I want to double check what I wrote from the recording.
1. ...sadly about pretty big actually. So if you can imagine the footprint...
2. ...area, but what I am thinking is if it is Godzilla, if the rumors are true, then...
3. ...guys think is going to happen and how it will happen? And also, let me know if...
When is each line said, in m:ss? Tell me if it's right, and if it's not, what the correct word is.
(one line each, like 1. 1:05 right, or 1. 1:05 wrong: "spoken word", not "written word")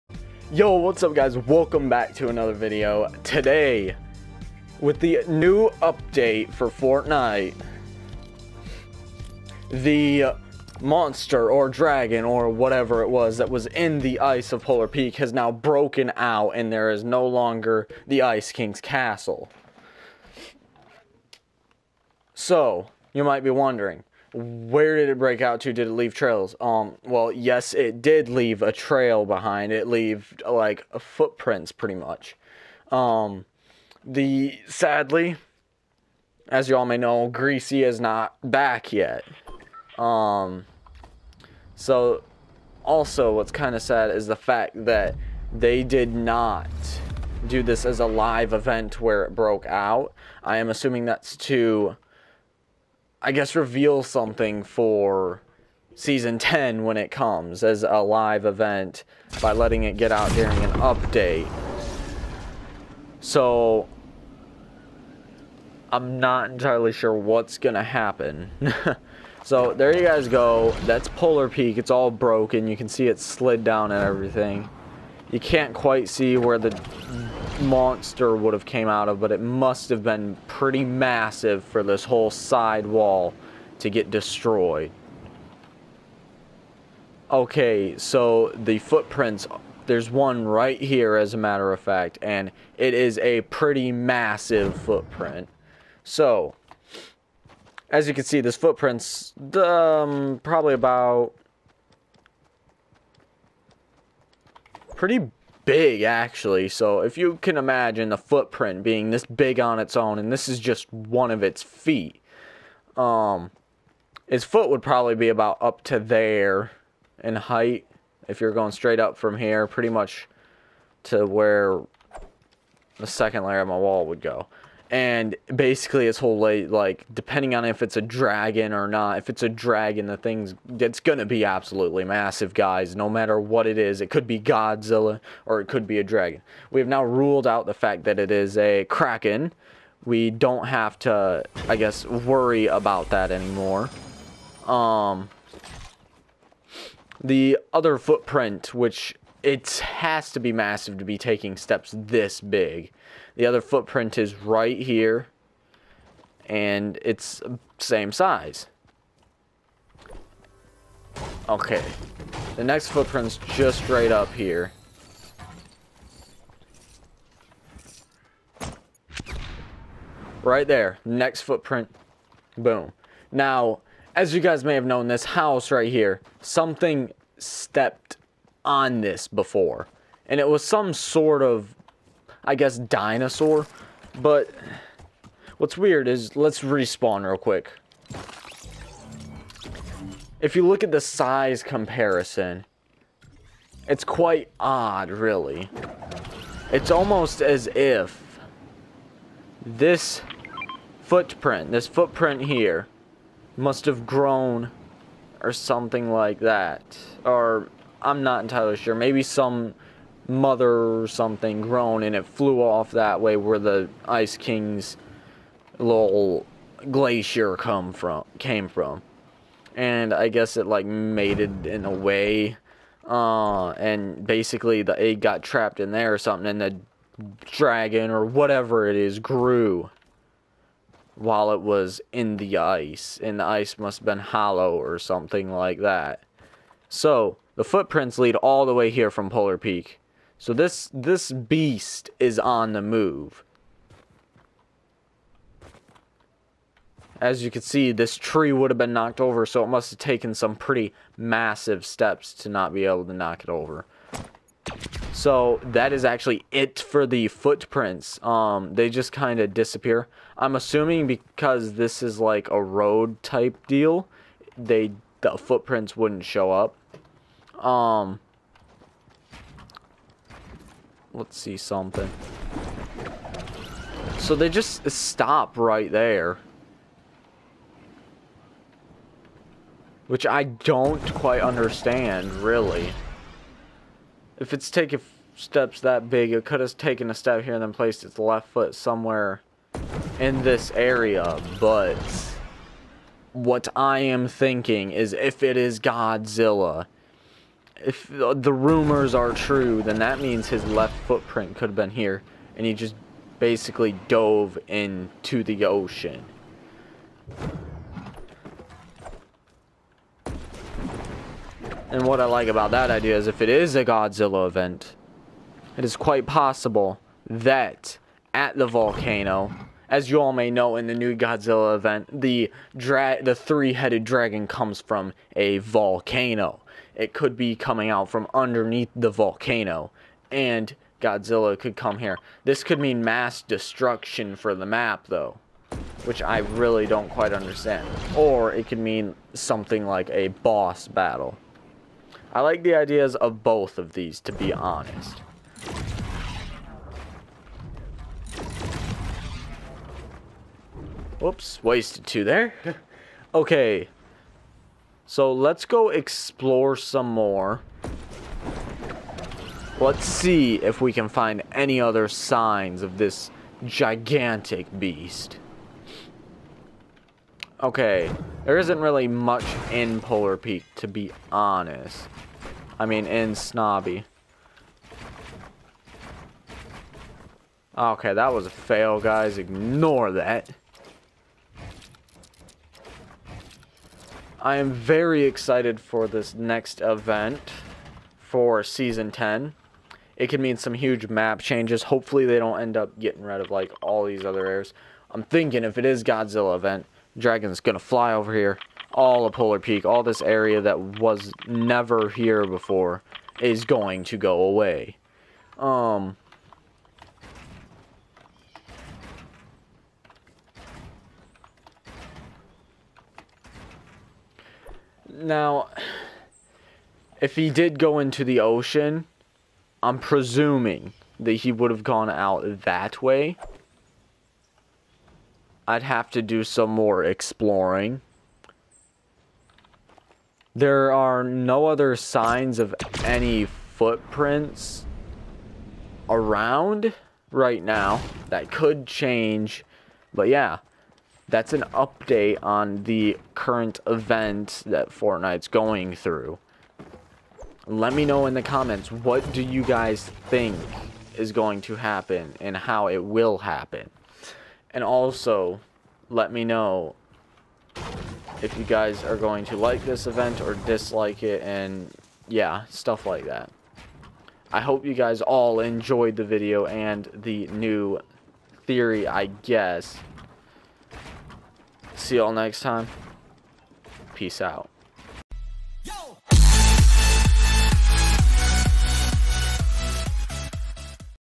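1. 1:40 wrong: "probably", not "sadly"
2. 4:50 right
3. 7:29 right.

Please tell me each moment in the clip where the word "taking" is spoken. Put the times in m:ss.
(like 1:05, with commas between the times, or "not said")
2:31, 4:44.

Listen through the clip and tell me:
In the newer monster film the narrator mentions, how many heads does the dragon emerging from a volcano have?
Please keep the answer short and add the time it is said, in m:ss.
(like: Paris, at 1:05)
3, at 5:23.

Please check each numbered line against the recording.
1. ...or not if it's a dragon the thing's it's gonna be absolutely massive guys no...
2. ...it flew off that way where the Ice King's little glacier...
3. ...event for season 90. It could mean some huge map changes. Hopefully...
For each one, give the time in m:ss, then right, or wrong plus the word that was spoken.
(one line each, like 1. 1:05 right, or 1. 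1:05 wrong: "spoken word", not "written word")
1. 2:08 right
2. 3:32 right
3. 6:26 wrong: "10", not "90".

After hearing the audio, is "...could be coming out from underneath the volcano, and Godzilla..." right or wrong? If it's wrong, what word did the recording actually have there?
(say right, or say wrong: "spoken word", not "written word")
right.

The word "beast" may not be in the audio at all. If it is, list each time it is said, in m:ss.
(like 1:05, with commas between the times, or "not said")
4:01, 6:04.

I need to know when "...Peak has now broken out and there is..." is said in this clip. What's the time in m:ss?
0:14.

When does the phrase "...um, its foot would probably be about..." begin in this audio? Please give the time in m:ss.
1:52.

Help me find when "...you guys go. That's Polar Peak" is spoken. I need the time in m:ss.
1:09.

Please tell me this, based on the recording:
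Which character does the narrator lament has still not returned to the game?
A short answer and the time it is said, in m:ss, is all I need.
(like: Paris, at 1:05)
Greasy, at 0:37.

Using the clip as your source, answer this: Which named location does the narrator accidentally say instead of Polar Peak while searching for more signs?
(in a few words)
Snobby.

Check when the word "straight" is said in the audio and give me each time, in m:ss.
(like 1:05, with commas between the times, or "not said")
1:58.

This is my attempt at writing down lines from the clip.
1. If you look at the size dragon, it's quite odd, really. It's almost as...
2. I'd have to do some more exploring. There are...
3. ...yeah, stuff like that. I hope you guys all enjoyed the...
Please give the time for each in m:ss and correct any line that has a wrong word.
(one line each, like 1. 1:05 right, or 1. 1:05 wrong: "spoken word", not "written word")
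1. 3:10 wrong: "comparison", not "dragon"
2. 7:05 right
3. 7:42 right.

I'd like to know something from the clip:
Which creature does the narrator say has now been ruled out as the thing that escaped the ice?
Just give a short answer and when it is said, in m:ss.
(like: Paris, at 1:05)
Kraken, at 2:18.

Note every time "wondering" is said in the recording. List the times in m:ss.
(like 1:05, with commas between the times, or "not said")
0:23.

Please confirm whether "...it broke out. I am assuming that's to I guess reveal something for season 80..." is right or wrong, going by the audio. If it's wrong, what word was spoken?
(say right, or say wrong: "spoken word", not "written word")
wrong: "10", not "80".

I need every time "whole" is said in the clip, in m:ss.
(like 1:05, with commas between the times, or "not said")
1:22, 2:06.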